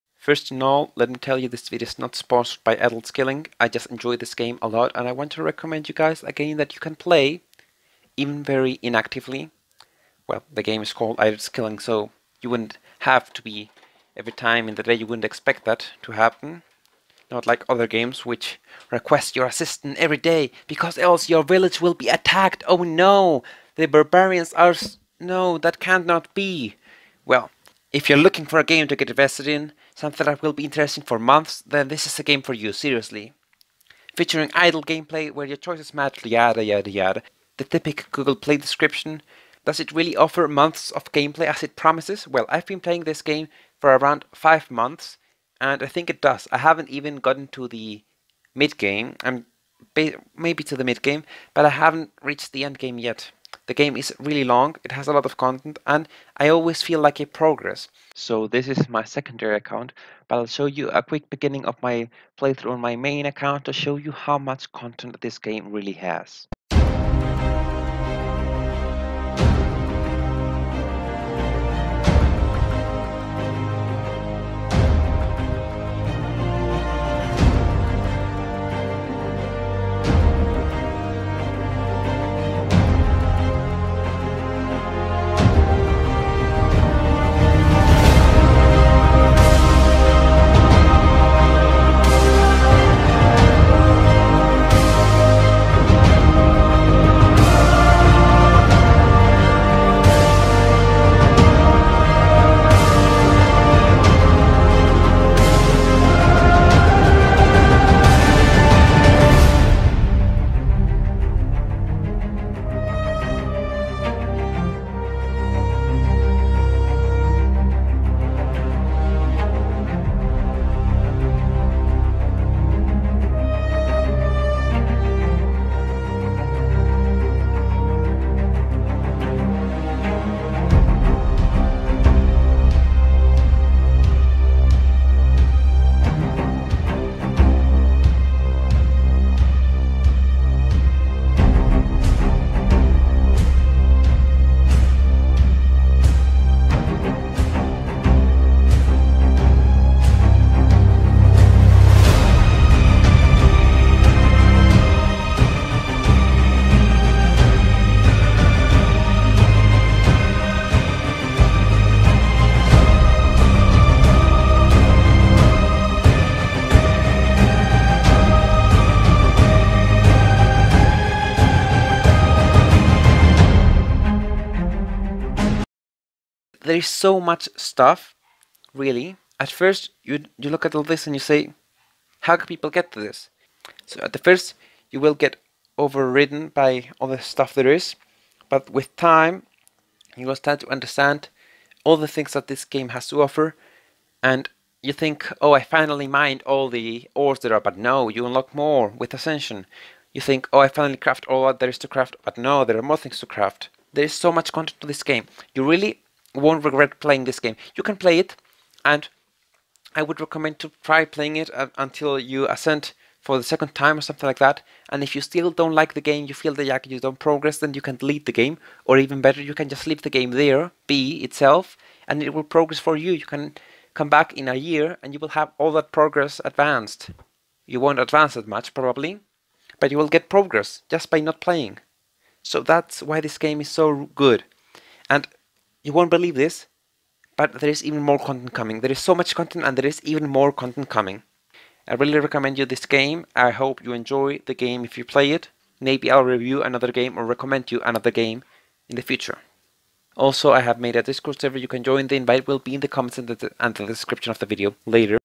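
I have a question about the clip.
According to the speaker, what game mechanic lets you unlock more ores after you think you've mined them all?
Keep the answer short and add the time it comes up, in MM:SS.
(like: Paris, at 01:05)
Ascension, at 03:19.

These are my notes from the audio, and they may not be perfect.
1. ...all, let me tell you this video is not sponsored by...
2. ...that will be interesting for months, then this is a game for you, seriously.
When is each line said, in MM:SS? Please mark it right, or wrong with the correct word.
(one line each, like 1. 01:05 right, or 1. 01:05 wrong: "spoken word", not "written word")
1. 00:00 right
2. 00:30 right.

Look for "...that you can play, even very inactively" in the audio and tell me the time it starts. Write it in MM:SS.
00:06.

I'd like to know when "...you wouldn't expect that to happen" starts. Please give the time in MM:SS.
00:14.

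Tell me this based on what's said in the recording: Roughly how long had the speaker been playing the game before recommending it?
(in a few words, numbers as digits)
5 months.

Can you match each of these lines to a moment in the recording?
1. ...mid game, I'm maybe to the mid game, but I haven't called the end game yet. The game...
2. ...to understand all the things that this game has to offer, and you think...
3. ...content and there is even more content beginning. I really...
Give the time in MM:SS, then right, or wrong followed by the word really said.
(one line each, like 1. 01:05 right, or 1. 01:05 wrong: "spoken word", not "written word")
1. 00:48 wrong: "reached", not "called"
2. 03:10 right
3. 03:59 wrong: "coming", not "beginning".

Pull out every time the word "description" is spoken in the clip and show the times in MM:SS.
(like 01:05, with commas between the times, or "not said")
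00:38, 04:13.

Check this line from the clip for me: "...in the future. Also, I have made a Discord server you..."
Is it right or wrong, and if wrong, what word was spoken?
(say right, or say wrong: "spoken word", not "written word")
right.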